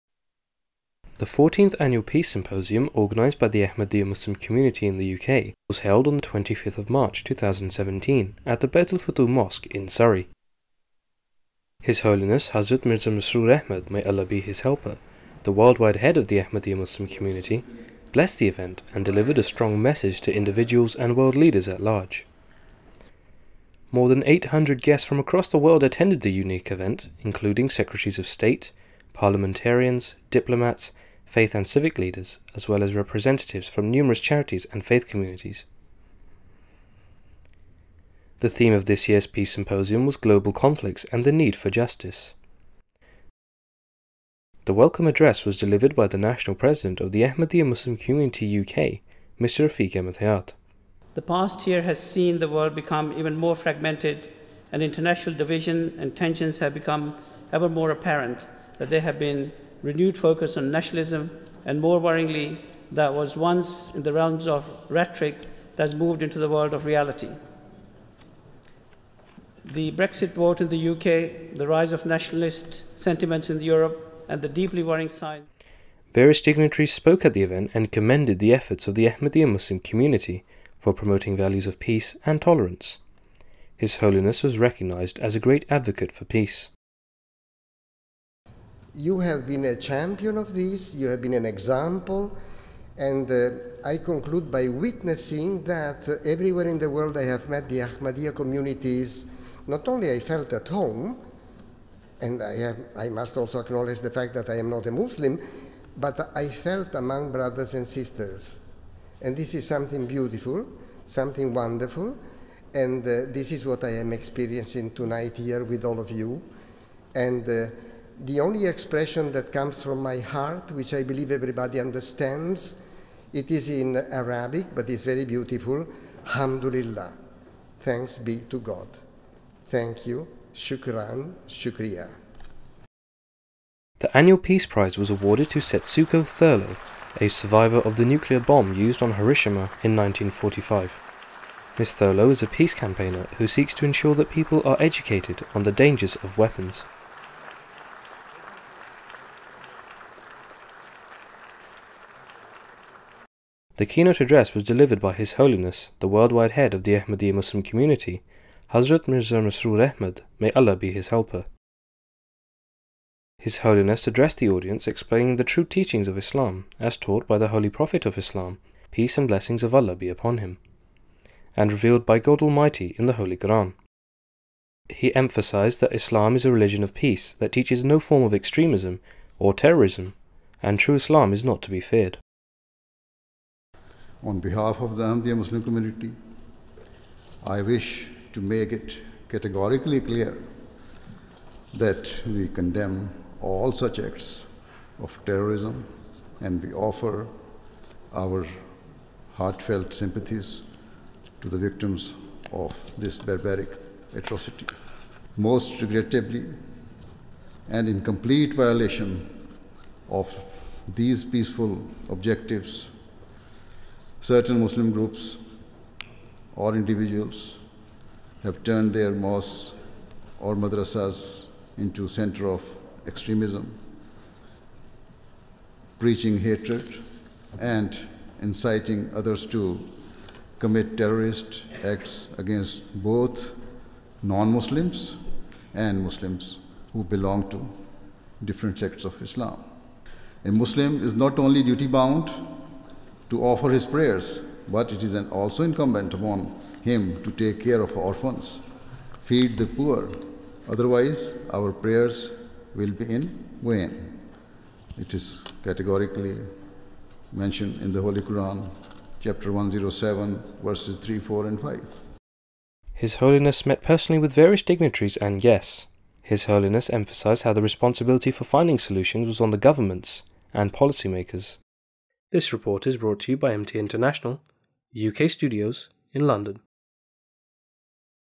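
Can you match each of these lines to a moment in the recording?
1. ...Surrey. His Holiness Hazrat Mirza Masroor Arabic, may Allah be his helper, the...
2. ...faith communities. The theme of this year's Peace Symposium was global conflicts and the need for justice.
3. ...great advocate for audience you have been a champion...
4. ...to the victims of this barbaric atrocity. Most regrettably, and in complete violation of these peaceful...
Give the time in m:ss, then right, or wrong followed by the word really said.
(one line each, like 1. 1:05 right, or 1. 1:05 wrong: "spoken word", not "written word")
1. 0:09 wrong: "Ahmad", not "Arabic"
2. 0:34 right
3. 1:25 wrong: "peace", not "audience"
4. 3:21 right.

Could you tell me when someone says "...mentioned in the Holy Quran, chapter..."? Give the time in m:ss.
4:17.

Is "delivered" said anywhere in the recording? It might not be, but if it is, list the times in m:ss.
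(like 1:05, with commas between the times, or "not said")
0:19, 0:45, 2:34.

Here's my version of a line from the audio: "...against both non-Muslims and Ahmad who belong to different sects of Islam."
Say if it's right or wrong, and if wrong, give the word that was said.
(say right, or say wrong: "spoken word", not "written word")
wrong: "Muslims", not "Ahmad".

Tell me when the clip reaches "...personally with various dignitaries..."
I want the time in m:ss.
4:23.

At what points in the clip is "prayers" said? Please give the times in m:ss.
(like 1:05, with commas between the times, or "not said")
4:03, 4:11.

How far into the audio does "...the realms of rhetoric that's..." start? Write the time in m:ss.
1:04.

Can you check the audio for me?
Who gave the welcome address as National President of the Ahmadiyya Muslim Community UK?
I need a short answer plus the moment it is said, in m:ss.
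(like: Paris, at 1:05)
Rafiq Hayat, at 0:49.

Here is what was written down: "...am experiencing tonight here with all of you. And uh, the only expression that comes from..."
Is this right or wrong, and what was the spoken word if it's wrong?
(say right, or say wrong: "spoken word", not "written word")
right.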